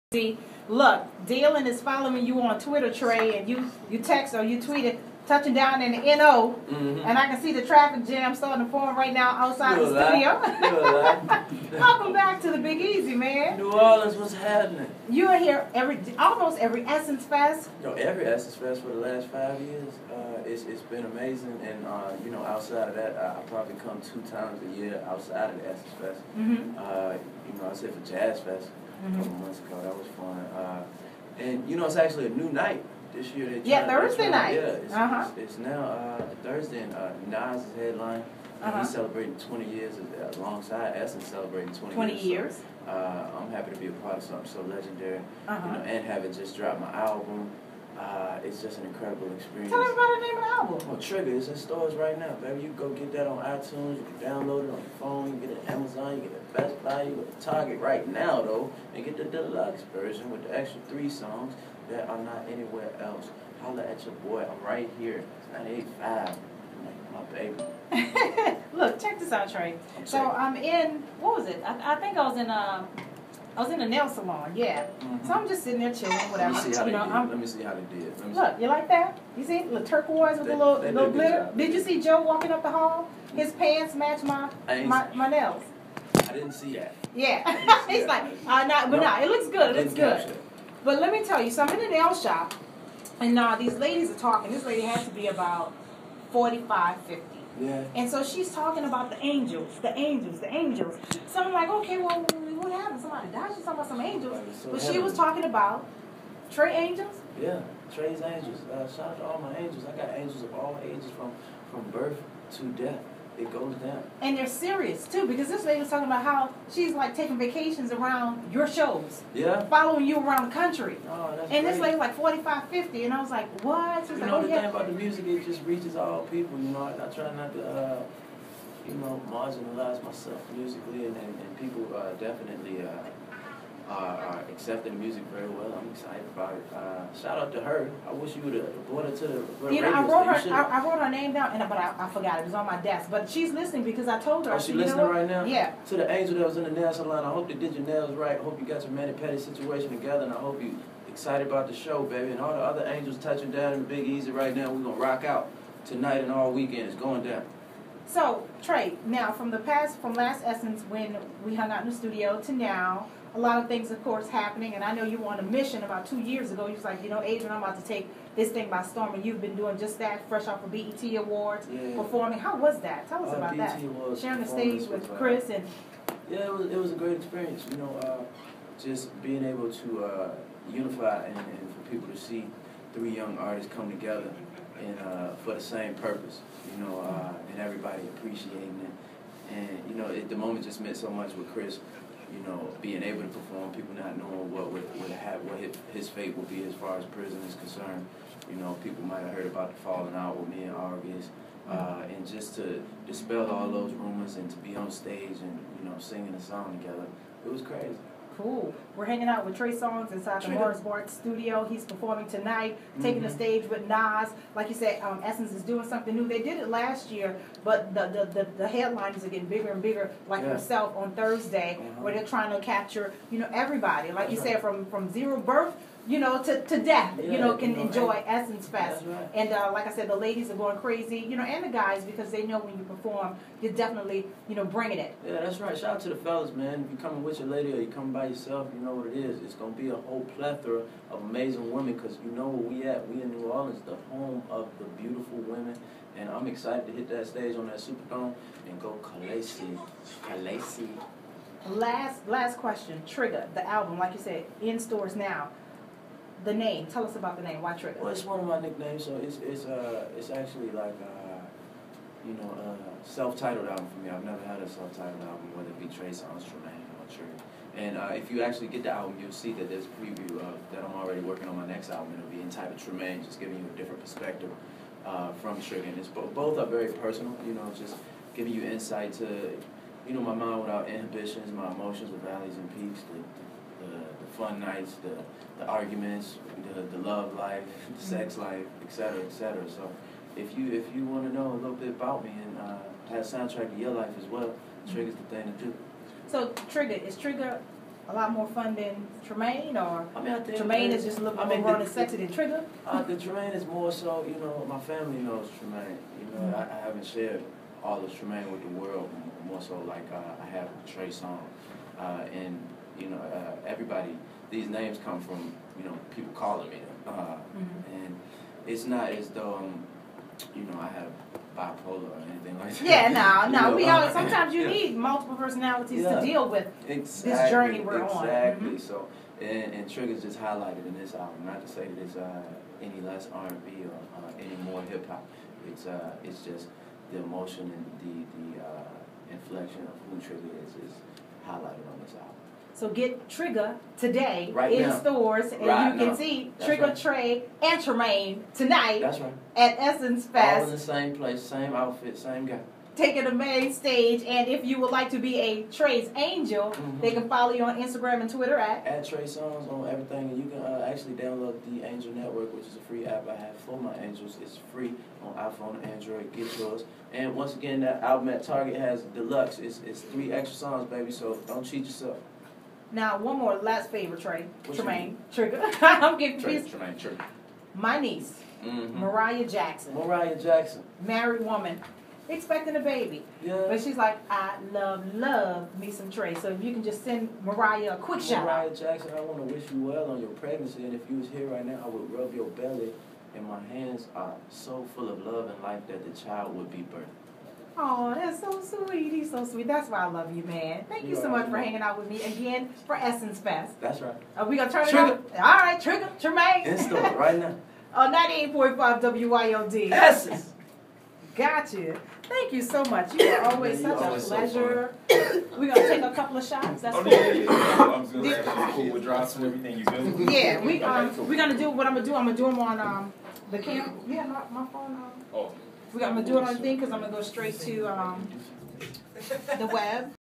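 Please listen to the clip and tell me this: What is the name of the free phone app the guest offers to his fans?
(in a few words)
Angel Network.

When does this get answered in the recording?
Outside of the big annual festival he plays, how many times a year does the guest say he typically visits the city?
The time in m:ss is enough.
0:24.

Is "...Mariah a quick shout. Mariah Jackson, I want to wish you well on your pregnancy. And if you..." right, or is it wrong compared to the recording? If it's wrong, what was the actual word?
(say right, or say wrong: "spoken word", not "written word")
right.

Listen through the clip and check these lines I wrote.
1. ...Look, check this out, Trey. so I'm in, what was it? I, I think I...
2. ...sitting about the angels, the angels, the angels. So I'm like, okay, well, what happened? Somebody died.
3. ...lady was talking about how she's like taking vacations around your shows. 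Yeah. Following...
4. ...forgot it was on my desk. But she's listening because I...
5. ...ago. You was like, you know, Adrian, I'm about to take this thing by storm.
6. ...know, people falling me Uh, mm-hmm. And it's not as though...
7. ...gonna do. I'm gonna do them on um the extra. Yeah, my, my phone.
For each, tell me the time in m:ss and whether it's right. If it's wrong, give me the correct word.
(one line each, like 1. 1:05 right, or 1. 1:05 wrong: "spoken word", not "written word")
1. 1:08 right
2. 1:38 wrong: "talking", not "sitting"
3. 1:55 right
4. 2:22 right
5. 2:46 right
6. 5:15 wrong: "calling", not "falling"
7. 7:01 wrong: "camera", not "extra".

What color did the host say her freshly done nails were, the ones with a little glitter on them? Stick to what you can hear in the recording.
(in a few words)
Turquoise.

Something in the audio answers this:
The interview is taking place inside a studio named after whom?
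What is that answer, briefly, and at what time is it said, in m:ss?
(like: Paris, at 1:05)
Morris Bart, at 3:30.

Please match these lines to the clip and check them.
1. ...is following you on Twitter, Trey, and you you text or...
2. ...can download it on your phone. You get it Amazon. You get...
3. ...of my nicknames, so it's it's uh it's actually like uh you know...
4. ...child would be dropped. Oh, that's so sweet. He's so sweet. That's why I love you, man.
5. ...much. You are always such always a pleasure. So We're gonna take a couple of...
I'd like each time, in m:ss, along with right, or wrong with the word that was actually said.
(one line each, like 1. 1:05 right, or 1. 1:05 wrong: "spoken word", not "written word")
1. 0:01 right
2. 0:54 right
3. 4:18 right
4. 6:36 wrong: "birthed", not "dropped"
5. 6:52 right.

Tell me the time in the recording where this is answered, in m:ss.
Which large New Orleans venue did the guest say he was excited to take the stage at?
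4:07.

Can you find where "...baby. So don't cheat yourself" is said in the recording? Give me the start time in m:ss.
6:10.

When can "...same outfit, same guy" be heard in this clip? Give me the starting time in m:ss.
5:51.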